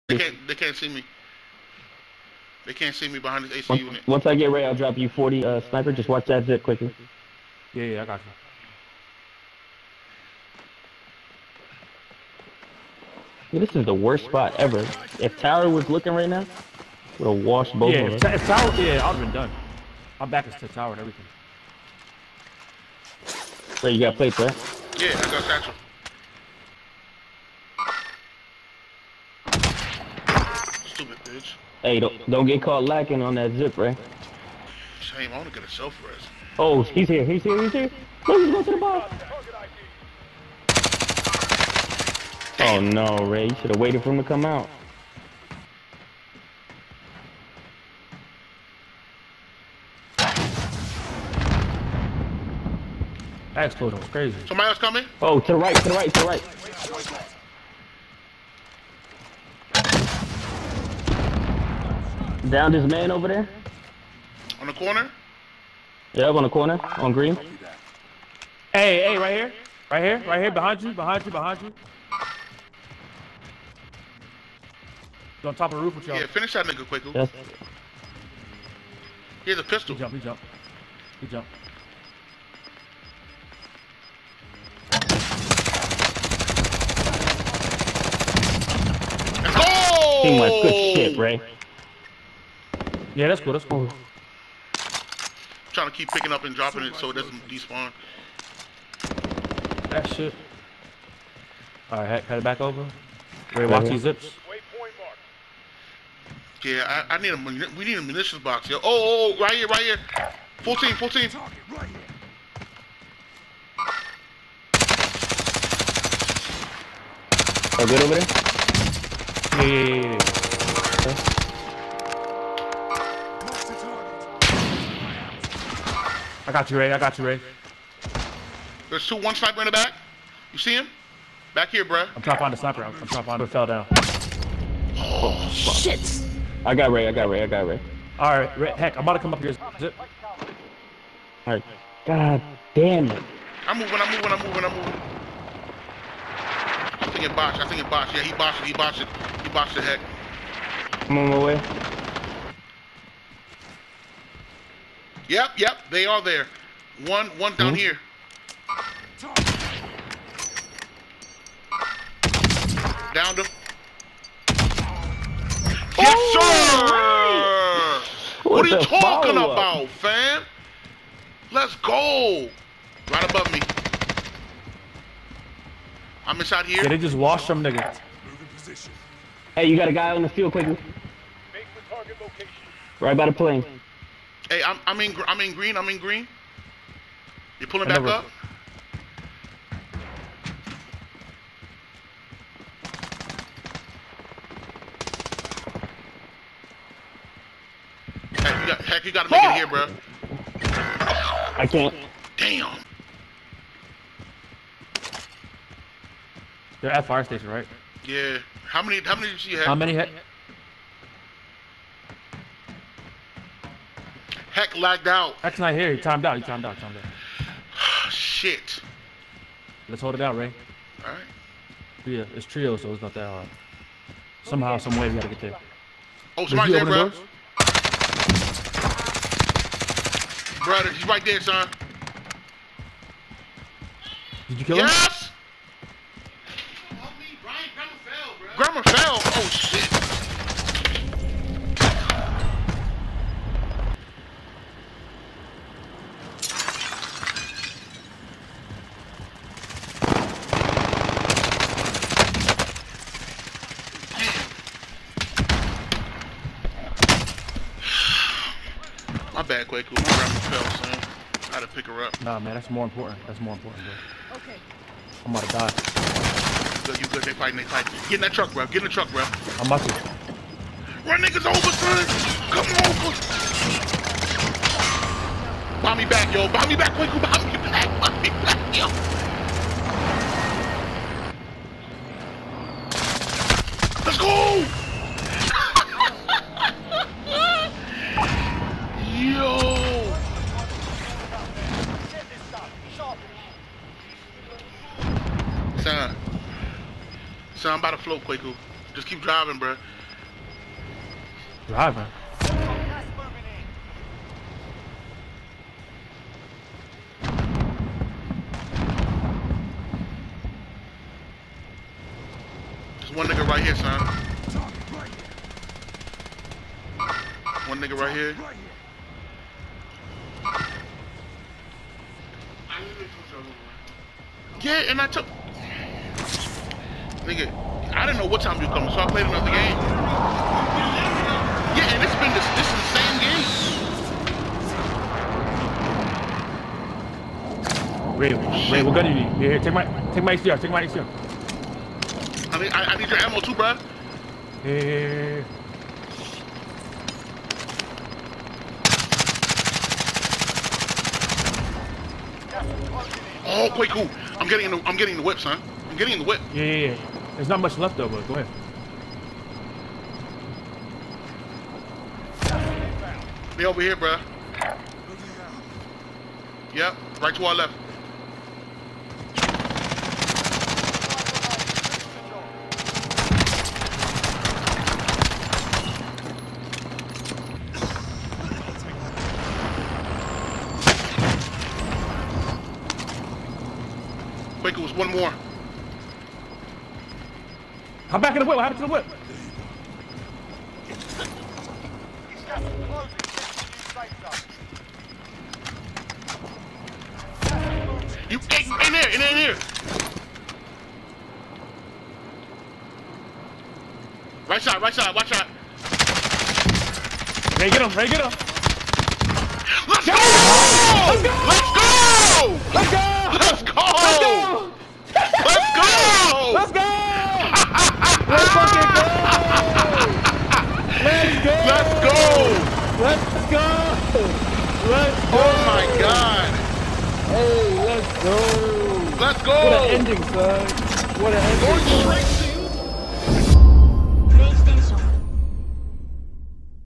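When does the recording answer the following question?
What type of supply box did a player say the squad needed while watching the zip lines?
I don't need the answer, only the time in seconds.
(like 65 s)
108 s.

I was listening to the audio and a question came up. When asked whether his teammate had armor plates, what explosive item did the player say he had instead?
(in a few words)
Satchel.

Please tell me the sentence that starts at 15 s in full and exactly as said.
If Tower was looking right now, would have washed both yeah, of them.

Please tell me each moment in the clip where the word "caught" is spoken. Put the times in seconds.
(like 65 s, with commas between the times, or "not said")
32 s.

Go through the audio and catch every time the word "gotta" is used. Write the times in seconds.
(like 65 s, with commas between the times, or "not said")
199 s, 225 s.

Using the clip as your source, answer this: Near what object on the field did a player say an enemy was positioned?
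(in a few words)
The plane.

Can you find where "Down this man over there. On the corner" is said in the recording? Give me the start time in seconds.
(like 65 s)
62 s.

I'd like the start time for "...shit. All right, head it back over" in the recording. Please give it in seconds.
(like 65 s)
100 s.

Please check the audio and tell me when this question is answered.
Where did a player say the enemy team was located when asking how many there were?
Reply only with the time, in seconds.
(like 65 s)
207 s.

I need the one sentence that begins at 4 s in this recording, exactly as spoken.
Once I get ready, I'll drop you 40 uh, sniper.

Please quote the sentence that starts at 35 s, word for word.
Shame, I want to get a self rest.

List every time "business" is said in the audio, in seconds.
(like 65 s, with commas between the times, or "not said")
not said.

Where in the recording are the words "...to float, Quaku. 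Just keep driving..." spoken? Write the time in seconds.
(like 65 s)
297 s.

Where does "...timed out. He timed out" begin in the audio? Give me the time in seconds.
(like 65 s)
216 s.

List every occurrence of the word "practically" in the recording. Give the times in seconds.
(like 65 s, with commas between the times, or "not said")
not said.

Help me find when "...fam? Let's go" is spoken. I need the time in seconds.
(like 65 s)
169 s.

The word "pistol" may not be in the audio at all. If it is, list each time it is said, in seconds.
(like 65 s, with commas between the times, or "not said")
79 s.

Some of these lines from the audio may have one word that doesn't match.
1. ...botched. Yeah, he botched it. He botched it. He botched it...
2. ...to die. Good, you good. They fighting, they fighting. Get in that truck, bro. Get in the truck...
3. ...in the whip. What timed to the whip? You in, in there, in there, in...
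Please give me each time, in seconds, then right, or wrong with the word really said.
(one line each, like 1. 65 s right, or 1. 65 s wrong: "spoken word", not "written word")
1. 147 s right
2. 265 s right
3. 388 s wrong: "happened", not "timed".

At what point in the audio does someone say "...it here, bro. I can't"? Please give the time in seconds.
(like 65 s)
199 s.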